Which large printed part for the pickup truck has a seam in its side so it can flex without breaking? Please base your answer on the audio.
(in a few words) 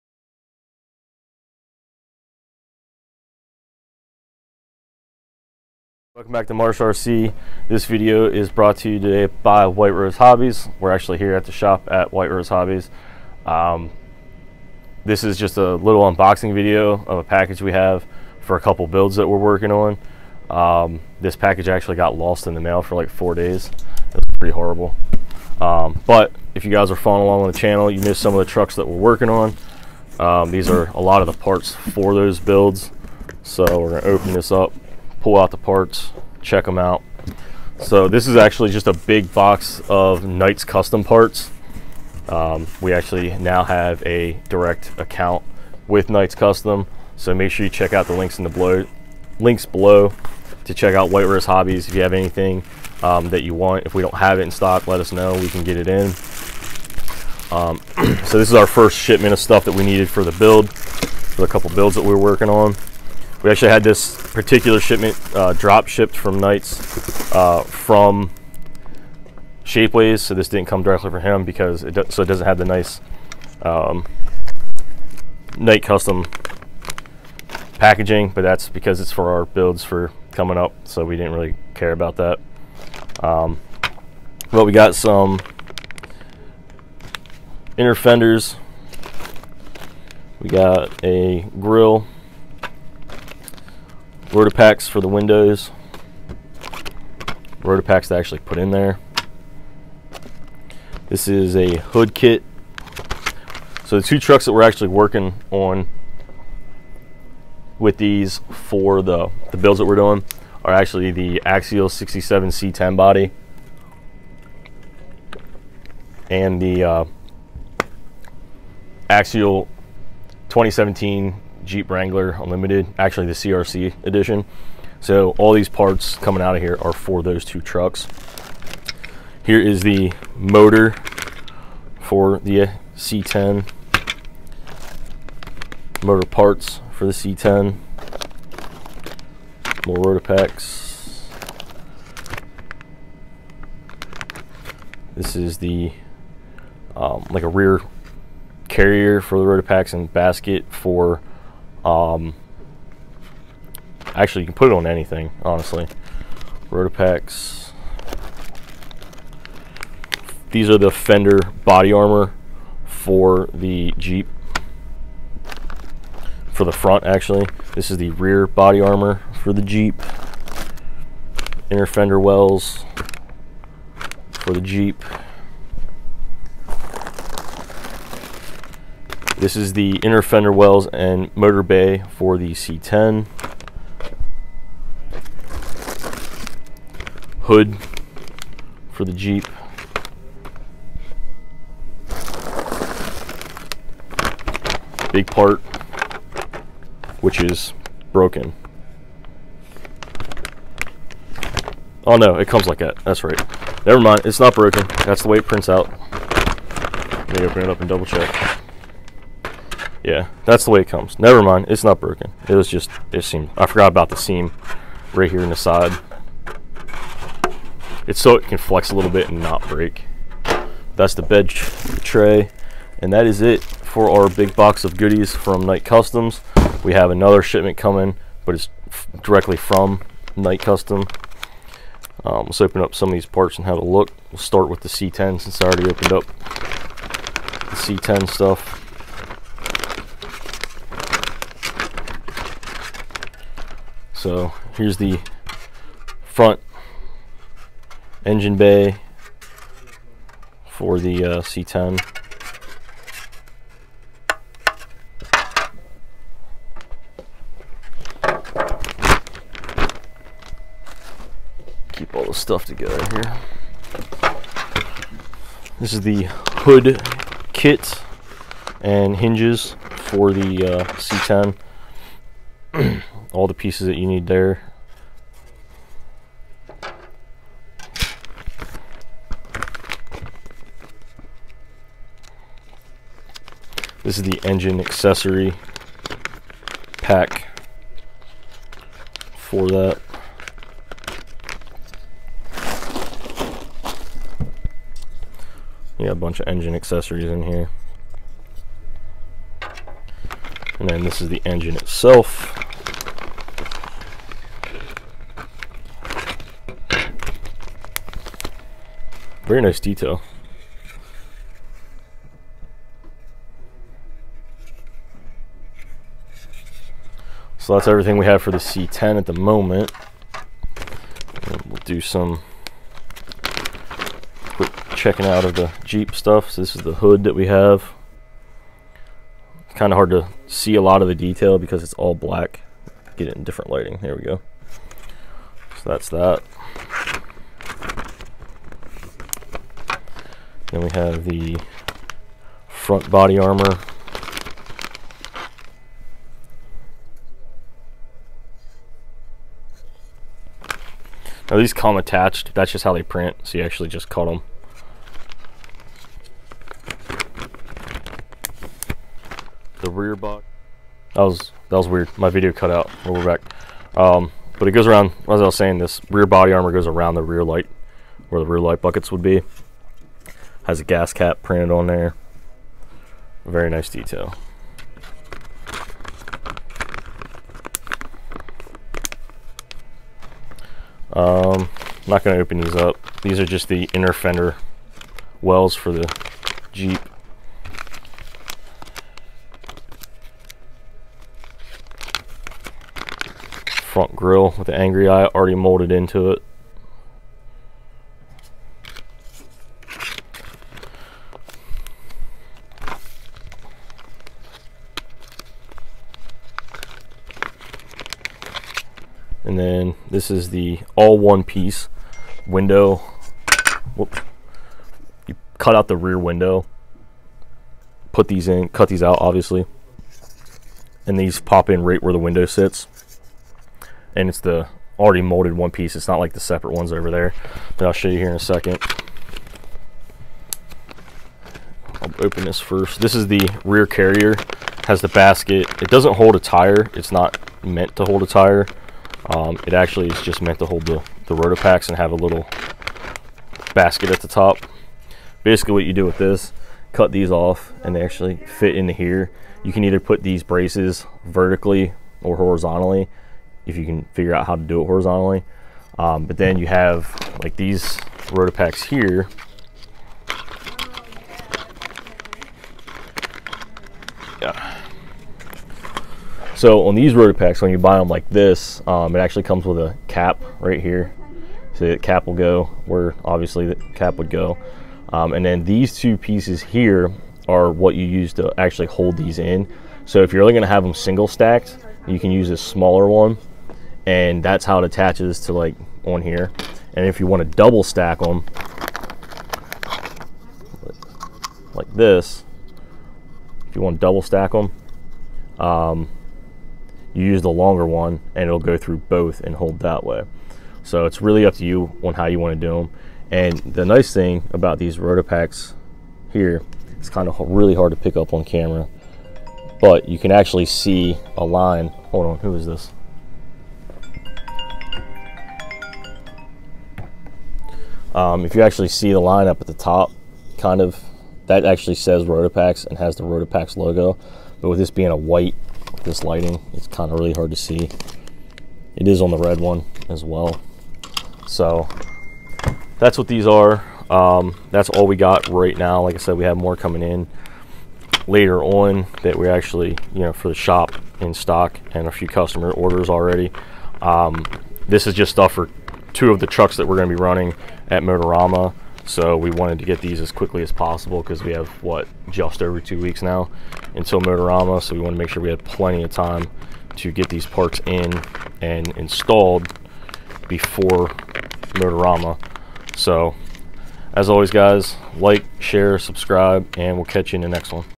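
Bed tray.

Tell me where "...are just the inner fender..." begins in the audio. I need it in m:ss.
6:23.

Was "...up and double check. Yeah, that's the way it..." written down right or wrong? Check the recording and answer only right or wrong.
right.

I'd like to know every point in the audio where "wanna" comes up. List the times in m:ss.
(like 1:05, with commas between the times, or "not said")
8:07, 8:13.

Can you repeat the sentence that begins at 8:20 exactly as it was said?
So it's really up to you on how you want to do them.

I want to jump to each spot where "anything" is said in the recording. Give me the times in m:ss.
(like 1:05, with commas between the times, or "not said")
0:52, 2:34.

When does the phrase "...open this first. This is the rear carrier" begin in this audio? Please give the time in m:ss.
7:12.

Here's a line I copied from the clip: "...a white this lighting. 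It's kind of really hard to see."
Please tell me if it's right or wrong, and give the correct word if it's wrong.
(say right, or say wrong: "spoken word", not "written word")
right.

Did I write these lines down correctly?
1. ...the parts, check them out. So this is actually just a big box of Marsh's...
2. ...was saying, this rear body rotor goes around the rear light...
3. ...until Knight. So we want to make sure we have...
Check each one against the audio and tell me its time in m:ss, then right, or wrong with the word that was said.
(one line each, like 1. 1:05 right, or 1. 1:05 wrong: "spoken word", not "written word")
1. 0:35 wrong: "Knight", not "Marsh"
2. 6:05 wrong: "armor", not "rotor"
3. 9:13 wrong: "Motorama", not "Knight".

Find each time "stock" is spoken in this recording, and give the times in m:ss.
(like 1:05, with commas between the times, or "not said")
0:54, 9:01.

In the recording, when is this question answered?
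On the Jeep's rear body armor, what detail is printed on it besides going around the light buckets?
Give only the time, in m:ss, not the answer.
6:10.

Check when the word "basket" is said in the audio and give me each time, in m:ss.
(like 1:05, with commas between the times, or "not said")
2:30, 7:15, 7:23.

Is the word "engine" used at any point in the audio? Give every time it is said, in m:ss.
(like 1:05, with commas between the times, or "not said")
4:08, 4:44, 4:56, 5:01.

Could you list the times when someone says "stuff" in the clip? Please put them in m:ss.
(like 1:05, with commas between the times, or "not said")
0:59, 3:58, 4:22, 5:26, 9:05.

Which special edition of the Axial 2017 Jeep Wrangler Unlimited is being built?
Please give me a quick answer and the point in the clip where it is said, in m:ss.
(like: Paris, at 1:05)
CRC edition, at 2:03.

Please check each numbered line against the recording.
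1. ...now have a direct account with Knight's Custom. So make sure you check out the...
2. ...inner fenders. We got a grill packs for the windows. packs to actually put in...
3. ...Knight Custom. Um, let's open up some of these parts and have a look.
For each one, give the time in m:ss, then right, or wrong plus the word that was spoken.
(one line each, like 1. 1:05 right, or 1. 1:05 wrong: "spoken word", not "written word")
1. 0:43 right
2. 1:27 right
3. 3:50 right.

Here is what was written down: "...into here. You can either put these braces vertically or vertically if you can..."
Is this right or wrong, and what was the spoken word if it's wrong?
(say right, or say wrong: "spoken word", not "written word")
wrong: "horizontally", not "vertically".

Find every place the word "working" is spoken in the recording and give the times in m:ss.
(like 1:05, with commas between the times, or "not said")
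0:19, 0:28, 1:02, 1:44.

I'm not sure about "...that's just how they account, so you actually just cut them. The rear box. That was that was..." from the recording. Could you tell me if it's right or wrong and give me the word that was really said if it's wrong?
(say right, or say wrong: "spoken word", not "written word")
wrong: "print", not "account".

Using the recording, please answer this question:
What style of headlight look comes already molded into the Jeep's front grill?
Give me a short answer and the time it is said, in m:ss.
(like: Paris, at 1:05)
Angry eye, at 6:34.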